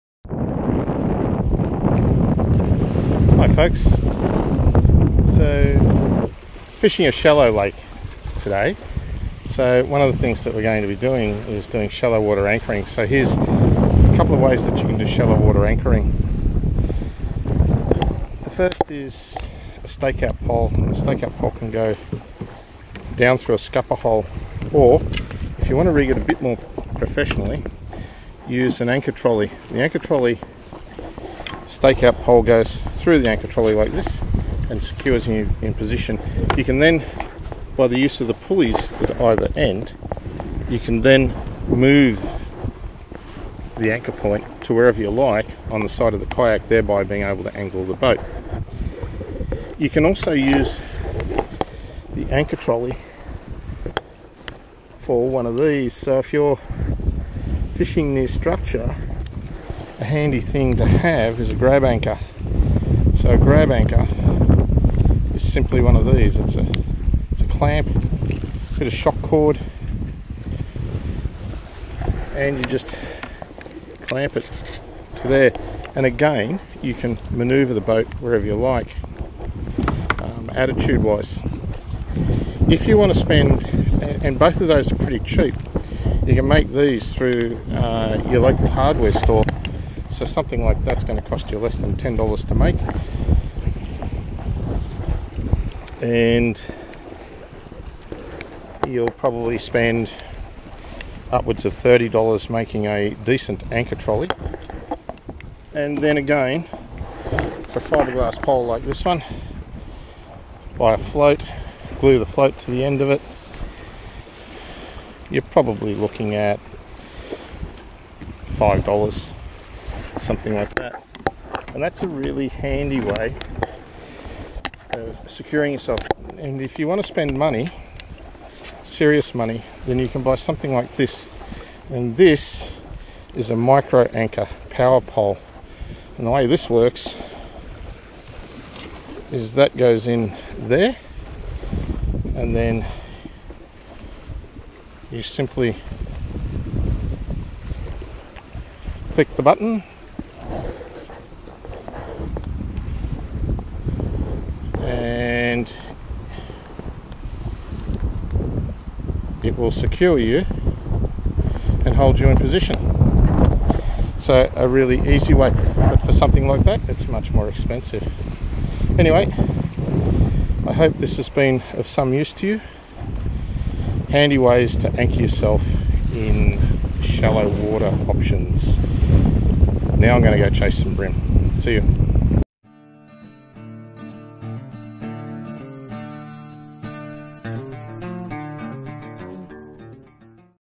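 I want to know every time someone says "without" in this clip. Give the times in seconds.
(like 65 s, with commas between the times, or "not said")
not said.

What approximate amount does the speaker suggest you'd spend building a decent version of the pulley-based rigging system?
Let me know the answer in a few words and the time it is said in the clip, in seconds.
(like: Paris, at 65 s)
$30, at 101 s.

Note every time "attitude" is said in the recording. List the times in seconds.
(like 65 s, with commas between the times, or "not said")
80 s.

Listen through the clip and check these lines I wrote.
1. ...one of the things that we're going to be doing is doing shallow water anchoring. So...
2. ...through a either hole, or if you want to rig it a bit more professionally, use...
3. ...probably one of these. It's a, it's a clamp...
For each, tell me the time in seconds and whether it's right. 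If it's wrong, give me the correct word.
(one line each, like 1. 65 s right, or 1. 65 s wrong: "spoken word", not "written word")
1. 9 s right
2. 23 s wrong: "scupper", not "either"
3. 65 s wrong: "simply", not "probably".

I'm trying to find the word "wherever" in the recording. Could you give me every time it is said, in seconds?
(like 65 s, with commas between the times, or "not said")
44 s, 78 s.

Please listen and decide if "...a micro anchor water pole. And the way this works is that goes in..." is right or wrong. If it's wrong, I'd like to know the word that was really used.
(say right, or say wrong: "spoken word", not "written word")
wrong: "power", not "water".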